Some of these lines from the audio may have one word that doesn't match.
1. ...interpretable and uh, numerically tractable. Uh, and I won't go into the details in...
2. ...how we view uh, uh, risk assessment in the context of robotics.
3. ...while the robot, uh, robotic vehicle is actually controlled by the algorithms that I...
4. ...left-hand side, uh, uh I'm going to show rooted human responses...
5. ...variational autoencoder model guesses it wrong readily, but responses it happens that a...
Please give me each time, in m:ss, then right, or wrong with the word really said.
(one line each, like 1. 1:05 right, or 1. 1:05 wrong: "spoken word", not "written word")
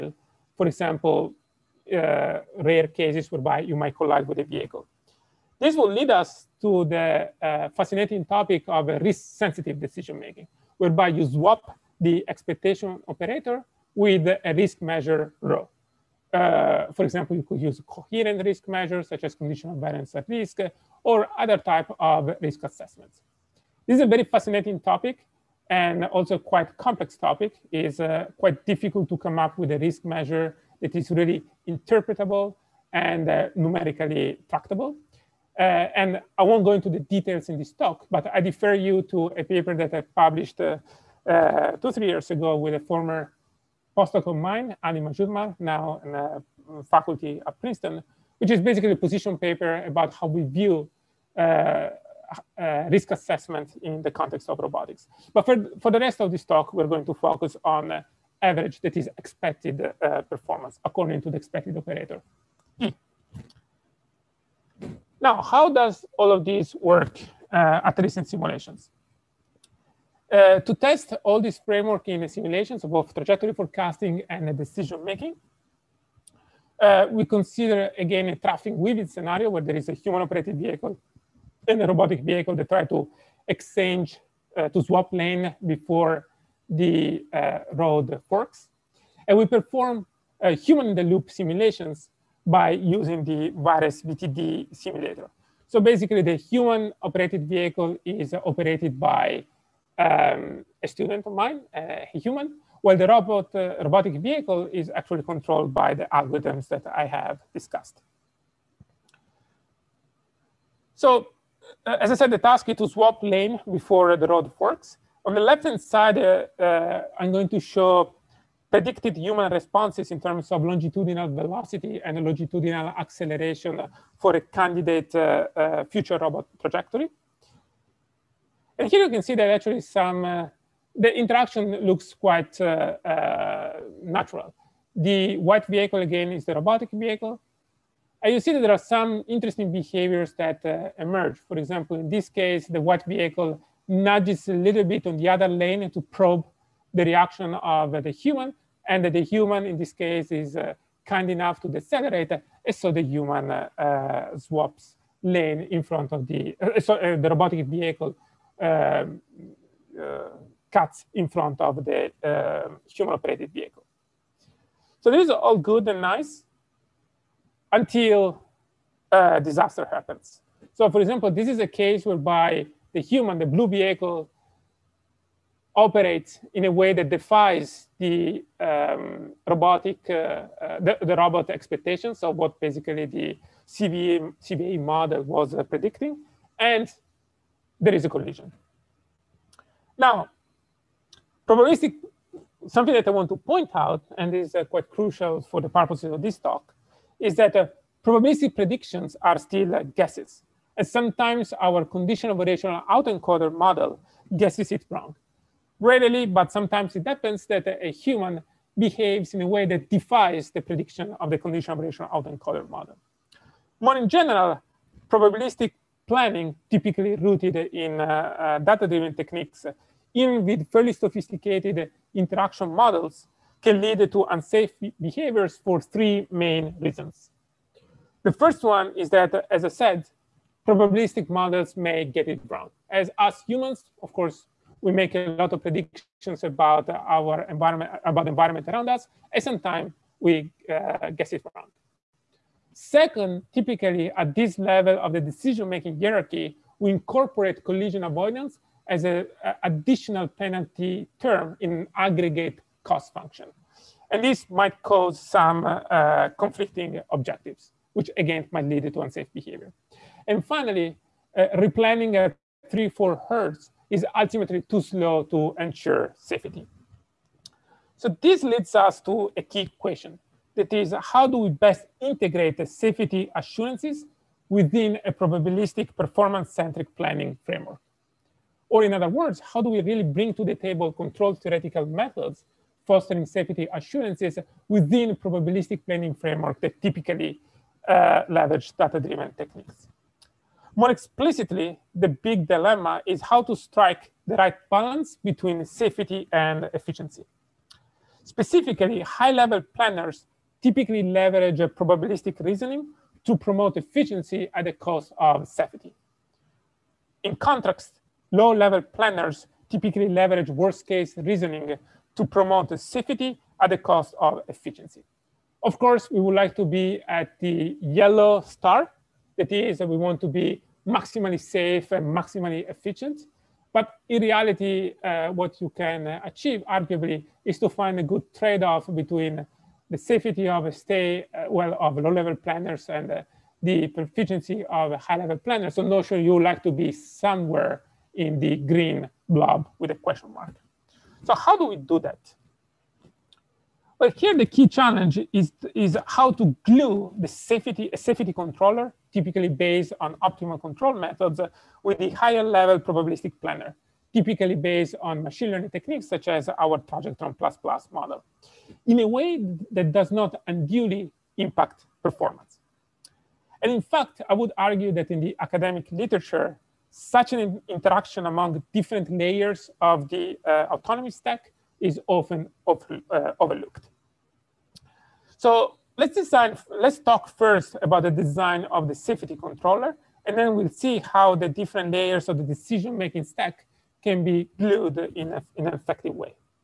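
1. 0:31 right
2. 0:50 right
3. 1:42 right
4. 1:55 wrong: "predicted", not "rooted"
5. 3:22 wrong: "sometimes", not "responses".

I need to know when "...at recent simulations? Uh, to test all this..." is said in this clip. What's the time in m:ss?
1:07.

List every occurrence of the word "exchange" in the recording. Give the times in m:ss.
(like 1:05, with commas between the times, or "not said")
1:23.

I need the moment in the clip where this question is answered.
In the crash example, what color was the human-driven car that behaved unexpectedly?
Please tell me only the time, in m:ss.
2:53.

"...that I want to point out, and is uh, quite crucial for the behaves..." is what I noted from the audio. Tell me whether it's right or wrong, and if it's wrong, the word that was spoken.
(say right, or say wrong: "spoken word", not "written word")
wrong: "purposes", not "behaves".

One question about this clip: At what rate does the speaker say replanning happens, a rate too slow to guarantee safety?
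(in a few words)
3-4 hertz.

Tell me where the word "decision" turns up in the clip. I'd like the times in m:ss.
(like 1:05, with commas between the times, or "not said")
0:09, 1:14, 4:05, 6:22.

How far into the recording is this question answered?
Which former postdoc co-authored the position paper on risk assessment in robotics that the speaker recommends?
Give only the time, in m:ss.
0:44.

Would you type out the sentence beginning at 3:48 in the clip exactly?
The first one is that, as I said, probabilistic models may get it wrong.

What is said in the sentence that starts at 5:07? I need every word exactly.
In contrast, low-level planners typically leverage worst-case reasoning to promote safety at the cost of efficiency.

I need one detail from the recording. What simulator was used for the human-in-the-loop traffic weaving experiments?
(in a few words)
VIRES VTD.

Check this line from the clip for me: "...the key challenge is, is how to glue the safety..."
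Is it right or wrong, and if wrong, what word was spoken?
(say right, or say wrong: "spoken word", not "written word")
right.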